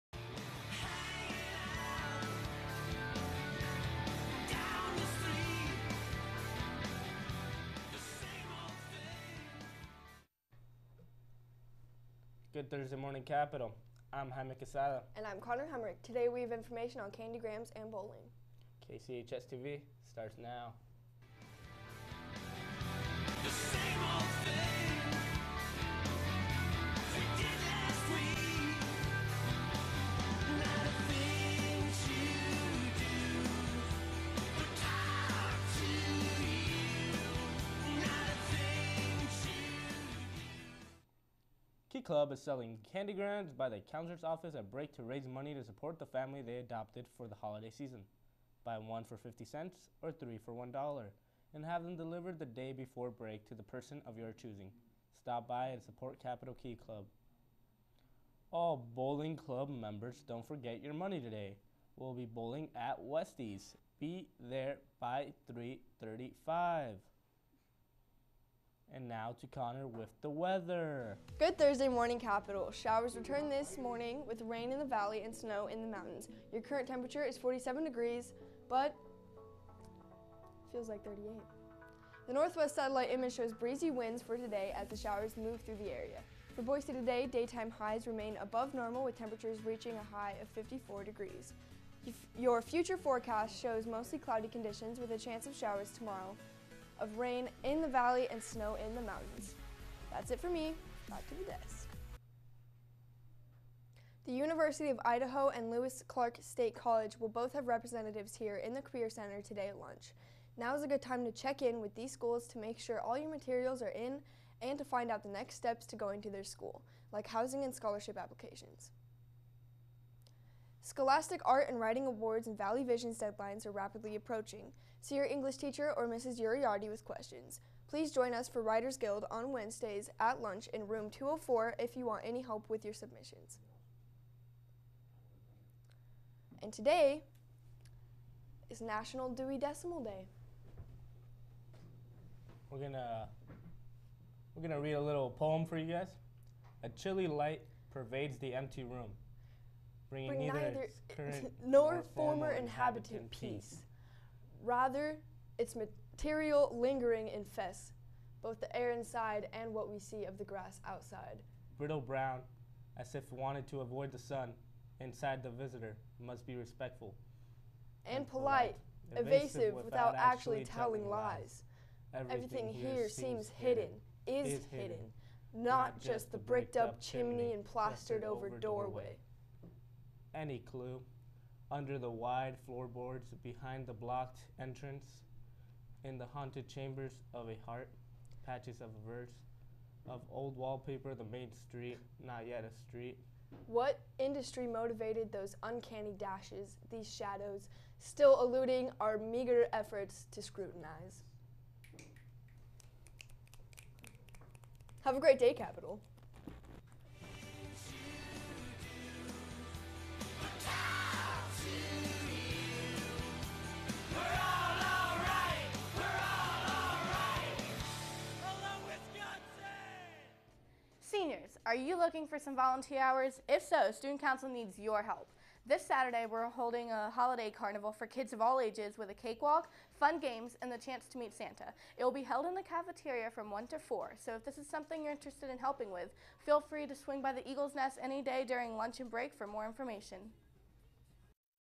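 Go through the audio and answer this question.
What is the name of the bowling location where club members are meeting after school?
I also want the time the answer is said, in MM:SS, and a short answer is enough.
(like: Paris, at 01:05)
Westies, at 01:03.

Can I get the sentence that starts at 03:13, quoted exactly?
What industry motivated those uncanny dashes, these shadows, still eluding our meager efforts to scrutinize?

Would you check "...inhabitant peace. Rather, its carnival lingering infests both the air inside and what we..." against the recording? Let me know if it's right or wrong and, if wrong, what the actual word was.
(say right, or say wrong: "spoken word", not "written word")
wrong: "material", not "carnival".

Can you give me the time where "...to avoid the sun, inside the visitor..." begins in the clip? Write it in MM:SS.
02:43.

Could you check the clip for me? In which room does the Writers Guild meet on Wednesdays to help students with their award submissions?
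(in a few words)
204.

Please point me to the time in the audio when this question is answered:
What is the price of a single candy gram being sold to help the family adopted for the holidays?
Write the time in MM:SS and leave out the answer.
00:49.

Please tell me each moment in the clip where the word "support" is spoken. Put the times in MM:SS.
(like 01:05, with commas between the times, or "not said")
00:45, 00:55.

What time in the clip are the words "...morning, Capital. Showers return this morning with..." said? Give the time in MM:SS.
01:11.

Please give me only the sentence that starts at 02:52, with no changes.
Everything, Everything here seems hidden, hidden is, is hidden, not, not just the bricked up chimney and plastered over doorway.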